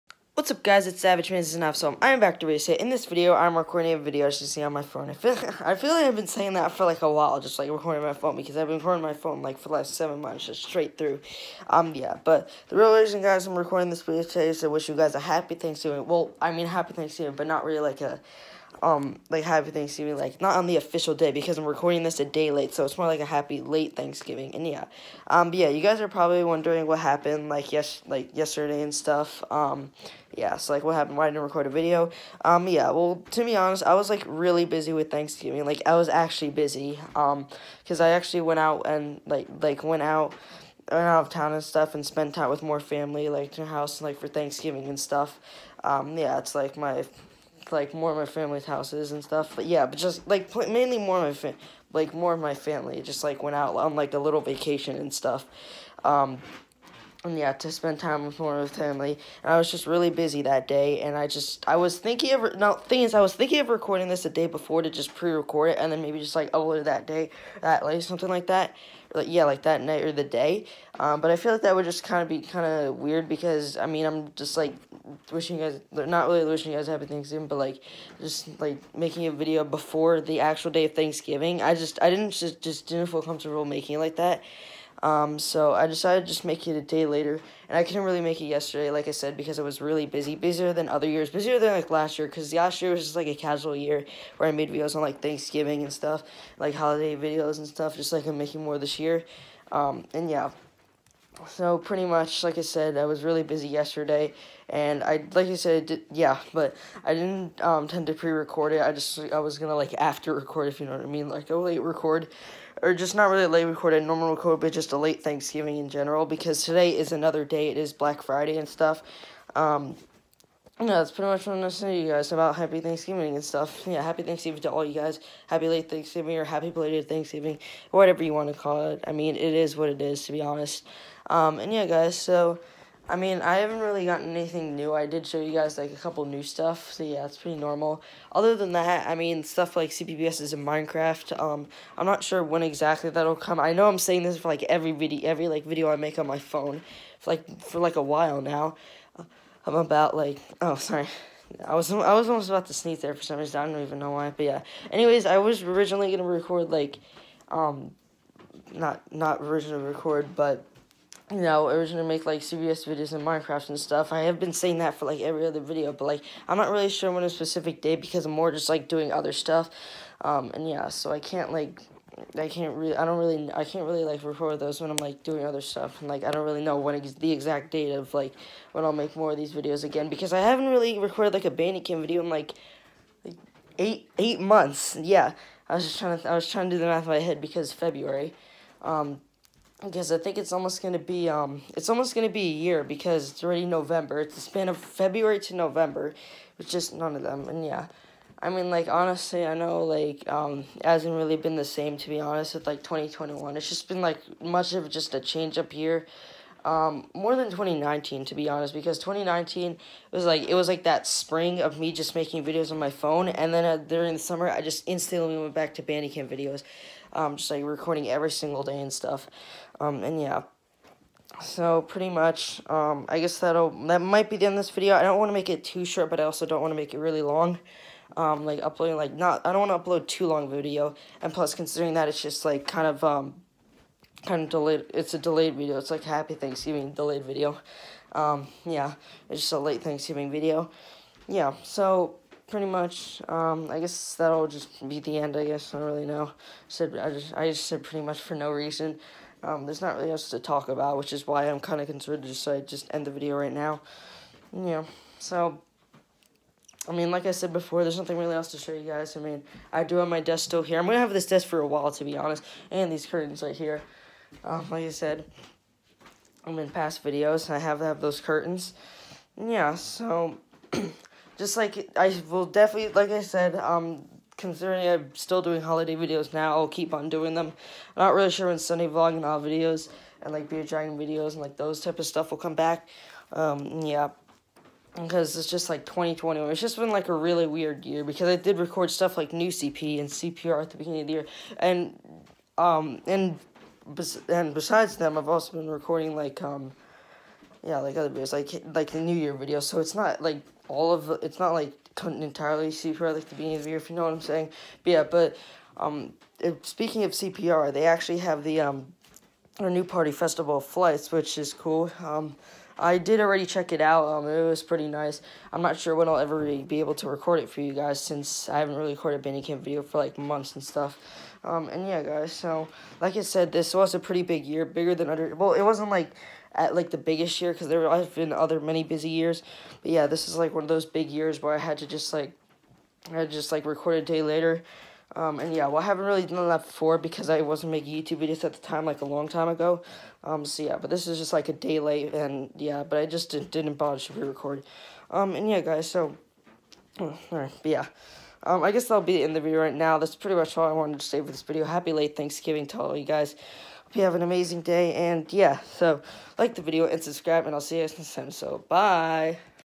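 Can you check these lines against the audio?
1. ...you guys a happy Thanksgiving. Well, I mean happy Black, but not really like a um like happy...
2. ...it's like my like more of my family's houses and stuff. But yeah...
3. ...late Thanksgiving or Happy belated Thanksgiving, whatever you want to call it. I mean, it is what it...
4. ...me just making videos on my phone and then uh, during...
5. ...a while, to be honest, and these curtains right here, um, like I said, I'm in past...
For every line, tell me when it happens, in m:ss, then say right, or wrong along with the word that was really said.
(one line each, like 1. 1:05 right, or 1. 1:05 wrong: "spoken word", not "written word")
1. 0:14 wrong: "Thanksgiving", not "Black"
2. 0:46 right
3. 2:05 right
4. 3:31 right
5. 4:21 right.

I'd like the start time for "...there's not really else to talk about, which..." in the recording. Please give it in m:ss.
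4:09.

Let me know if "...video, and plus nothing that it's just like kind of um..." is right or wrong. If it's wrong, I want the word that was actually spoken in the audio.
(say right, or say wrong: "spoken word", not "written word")
wrong: "considering", not "nothing".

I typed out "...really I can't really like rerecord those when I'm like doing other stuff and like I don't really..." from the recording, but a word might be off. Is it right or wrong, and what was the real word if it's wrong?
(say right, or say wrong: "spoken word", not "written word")
wrong: "record", not "rerecord".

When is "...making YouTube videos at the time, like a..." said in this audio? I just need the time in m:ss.
5:37.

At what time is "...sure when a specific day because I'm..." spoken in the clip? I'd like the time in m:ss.
2:46.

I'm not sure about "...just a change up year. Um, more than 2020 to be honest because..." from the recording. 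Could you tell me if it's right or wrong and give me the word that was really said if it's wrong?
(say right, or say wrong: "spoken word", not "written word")
wrong: "2019", not "2020".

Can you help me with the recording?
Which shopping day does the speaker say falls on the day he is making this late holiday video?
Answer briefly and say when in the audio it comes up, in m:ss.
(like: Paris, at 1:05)
Black Friday, at 1:57.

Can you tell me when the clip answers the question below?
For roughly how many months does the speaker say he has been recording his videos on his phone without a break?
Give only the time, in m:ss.
0:09.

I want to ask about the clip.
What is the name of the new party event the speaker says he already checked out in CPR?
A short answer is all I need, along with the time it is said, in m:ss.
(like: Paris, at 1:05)
Festival of Flights, at 5:10.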